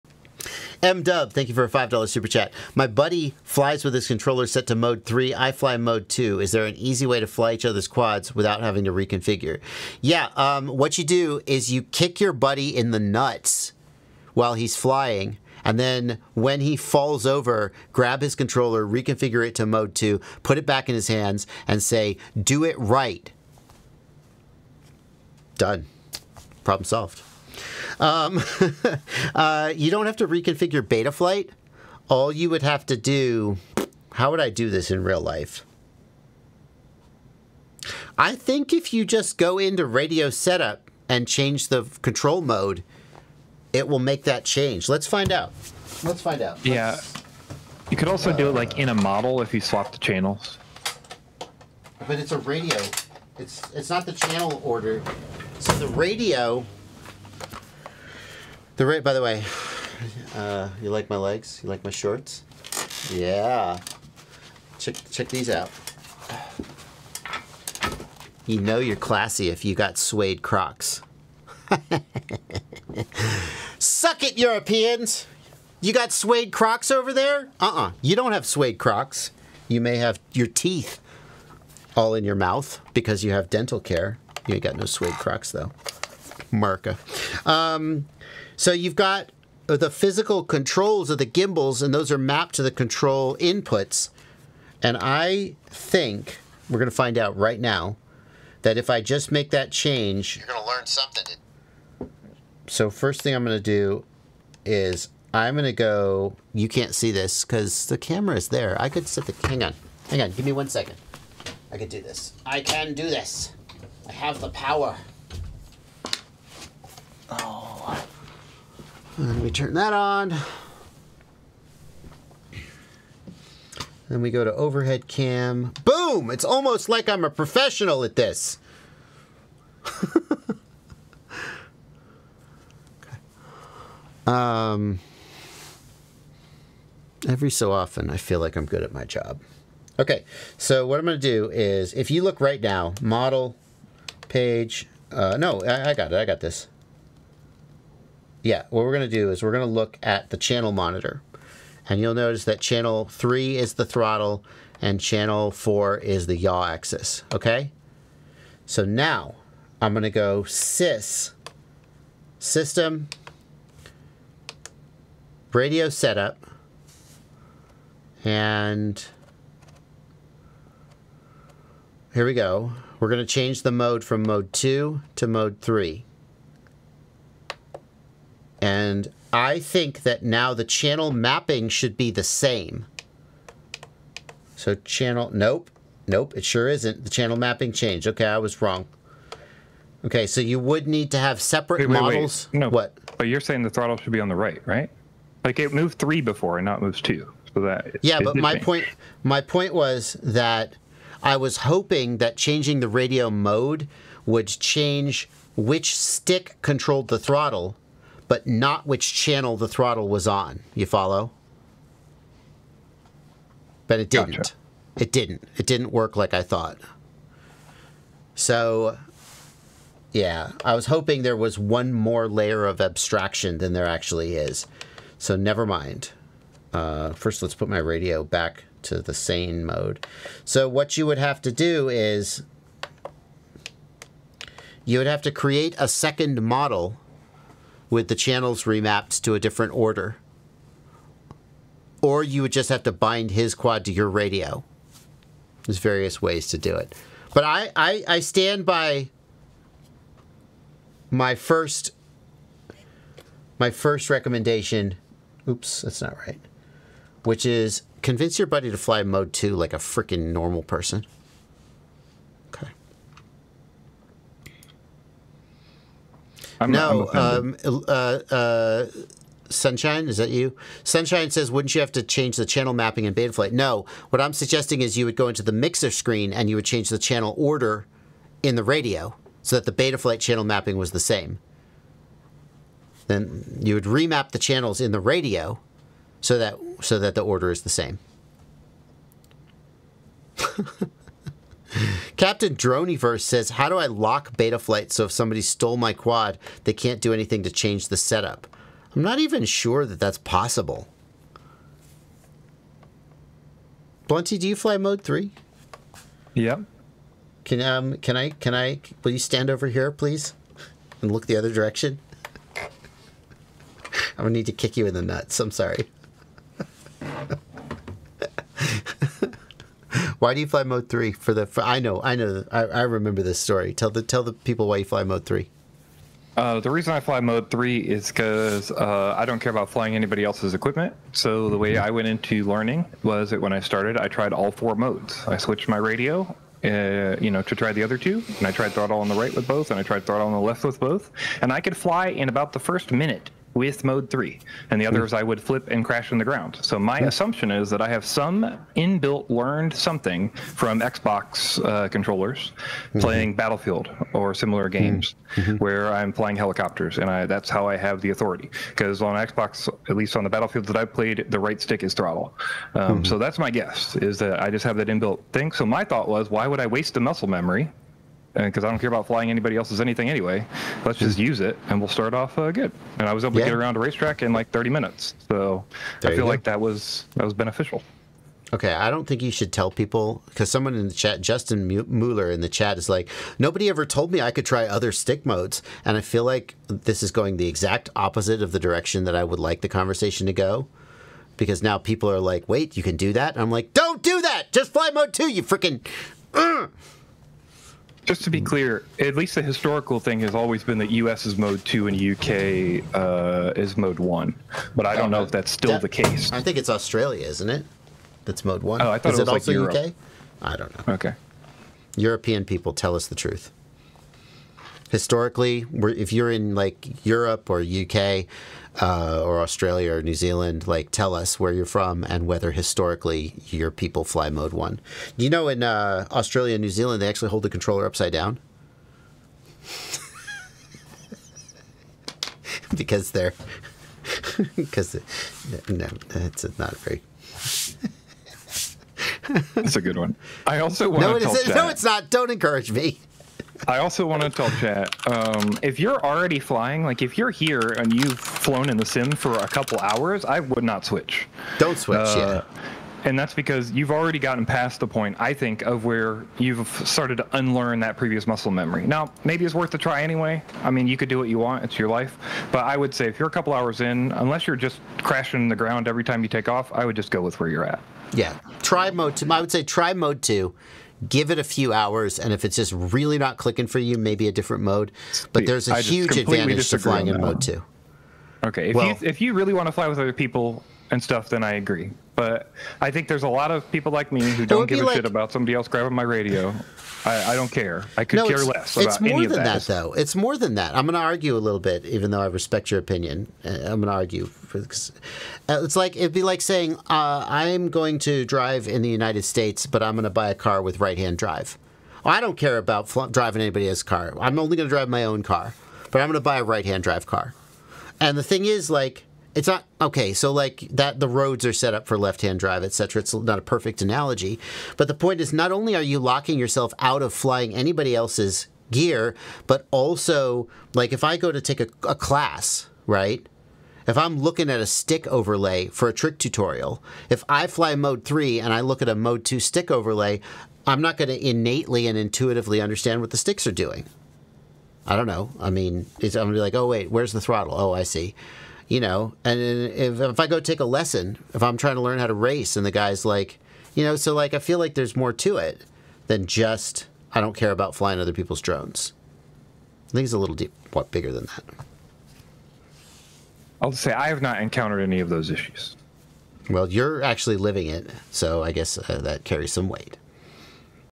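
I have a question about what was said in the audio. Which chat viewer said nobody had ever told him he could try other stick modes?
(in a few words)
Justin Mueller.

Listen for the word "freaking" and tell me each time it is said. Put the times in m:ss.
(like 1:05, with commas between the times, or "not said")
4:19, 6:35.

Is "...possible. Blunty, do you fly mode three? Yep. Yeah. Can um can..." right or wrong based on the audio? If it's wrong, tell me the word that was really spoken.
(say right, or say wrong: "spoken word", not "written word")
right.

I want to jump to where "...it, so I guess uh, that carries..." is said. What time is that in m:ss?
9:17.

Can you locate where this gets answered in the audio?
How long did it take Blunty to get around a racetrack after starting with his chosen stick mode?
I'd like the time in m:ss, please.
6:14.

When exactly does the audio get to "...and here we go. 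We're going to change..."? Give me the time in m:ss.
2:48.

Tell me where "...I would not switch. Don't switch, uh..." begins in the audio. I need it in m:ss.
7:30.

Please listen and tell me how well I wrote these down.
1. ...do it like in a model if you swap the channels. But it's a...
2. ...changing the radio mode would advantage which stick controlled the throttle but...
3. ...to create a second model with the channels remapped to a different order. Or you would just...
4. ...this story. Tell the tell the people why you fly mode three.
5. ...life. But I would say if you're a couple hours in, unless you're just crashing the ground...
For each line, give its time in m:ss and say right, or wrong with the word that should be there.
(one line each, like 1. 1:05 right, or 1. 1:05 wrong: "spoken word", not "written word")
1. 0:48 right
2. 3:22 wrong: "change", not "advantage"
3. 3:55 right
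4. 5:23 right
5. 7:41 right.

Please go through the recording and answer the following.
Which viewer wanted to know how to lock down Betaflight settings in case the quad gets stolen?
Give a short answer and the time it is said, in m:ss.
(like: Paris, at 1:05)
Captain Droniverse, at 4:52.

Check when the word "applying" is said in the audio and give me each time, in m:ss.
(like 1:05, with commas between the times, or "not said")
not said.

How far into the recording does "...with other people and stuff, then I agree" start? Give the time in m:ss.
7:59.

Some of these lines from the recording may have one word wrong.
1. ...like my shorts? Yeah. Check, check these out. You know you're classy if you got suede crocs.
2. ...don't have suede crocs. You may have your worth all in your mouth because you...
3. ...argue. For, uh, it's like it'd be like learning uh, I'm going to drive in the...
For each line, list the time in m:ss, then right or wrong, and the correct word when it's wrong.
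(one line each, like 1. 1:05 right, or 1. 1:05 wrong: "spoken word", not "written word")
1. 1:01 right
2. 1:18 wrong: "teeth", not "worth"
3. 8:13 wrong: "saying", not "learning".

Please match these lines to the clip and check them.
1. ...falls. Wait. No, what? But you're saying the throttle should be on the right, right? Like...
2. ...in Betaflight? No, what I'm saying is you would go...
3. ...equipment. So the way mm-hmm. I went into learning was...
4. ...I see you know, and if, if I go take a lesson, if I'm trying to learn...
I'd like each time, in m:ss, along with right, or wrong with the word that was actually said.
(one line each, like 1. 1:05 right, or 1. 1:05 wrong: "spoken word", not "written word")
1. 3:12 wrong: "models", not "falls"
2. 4:33 wrong: "suggesting", not "saying"
3. 5:30 right
4. 8:57 right.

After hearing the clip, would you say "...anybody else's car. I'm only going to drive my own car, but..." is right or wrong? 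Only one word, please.
right.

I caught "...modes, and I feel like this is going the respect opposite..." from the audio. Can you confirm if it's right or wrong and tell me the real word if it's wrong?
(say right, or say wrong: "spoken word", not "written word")
wrong: "exact", not "respect".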